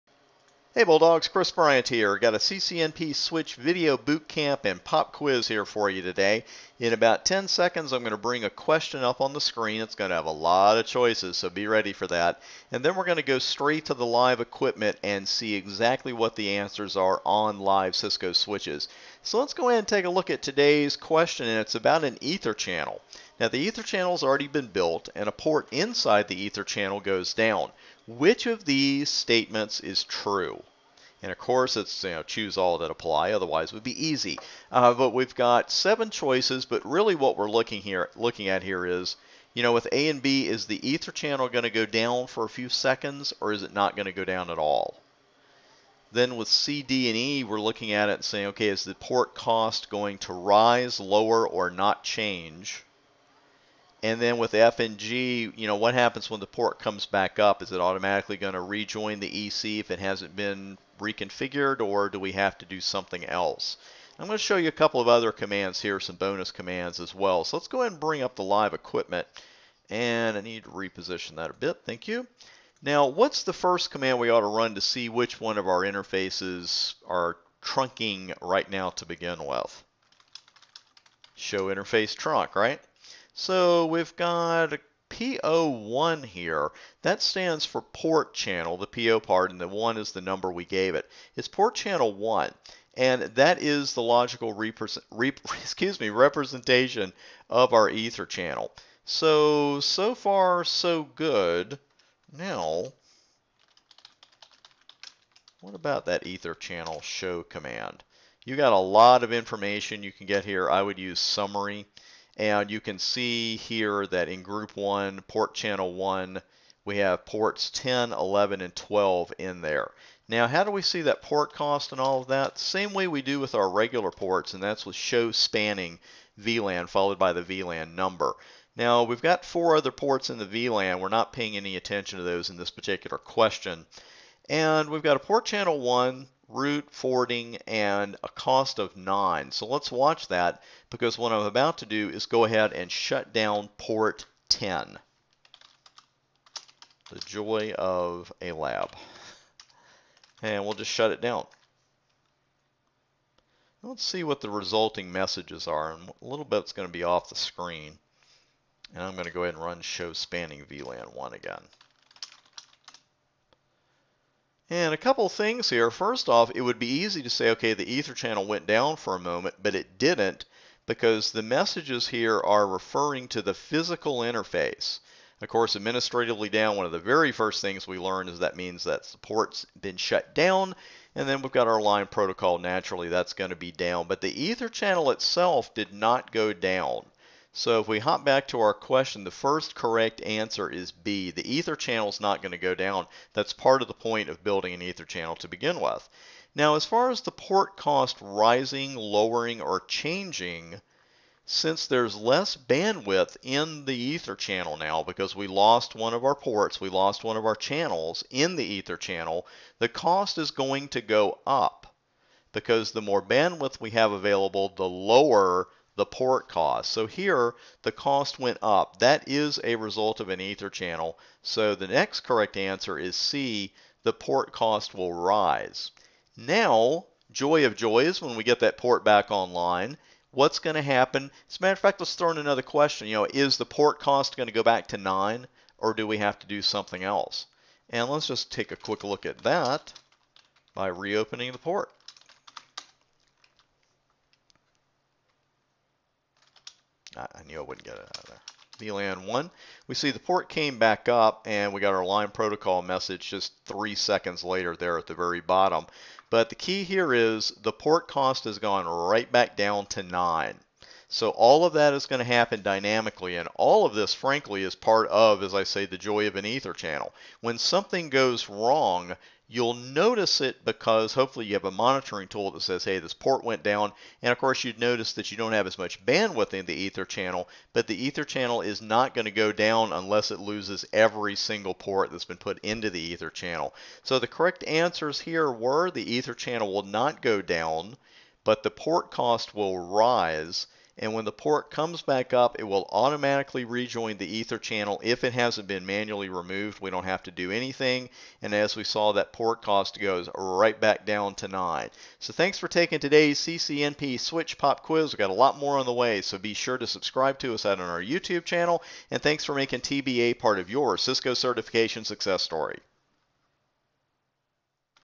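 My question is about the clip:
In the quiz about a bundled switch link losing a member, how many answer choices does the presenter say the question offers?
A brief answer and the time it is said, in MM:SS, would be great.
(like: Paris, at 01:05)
7, at 00:35.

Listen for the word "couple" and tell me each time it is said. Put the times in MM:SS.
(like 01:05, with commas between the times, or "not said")
01:04, 02:44.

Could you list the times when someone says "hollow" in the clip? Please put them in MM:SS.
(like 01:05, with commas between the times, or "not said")
not said.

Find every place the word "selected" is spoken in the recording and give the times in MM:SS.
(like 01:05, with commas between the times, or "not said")
not said.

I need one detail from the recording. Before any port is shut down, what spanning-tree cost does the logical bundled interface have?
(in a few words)
9.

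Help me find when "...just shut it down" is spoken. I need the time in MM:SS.
02:30.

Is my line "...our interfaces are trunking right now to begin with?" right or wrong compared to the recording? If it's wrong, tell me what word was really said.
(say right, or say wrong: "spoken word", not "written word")
right.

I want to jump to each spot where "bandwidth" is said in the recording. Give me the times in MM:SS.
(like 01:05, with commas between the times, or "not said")
03:22, 03:33, 04:36.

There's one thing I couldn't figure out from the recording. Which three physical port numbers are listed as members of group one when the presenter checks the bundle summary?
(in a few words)
10, 11, and 12.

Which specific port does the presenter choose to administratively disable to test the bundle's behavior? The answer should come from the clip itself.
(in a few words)
Port 10.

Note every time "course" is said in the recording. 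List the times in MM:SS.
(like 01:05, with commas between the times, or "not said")
00:31, 02:55, 04:34.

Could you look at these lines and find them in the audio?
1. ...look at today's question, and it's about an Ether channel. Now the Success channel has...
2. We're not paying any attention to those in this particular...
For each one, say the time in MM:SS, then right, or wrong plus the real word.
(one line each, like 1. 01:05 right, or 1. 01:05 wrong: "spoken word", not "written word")
1. 00:20 wrong: "Ether", not "Success"
2. 02:10 right.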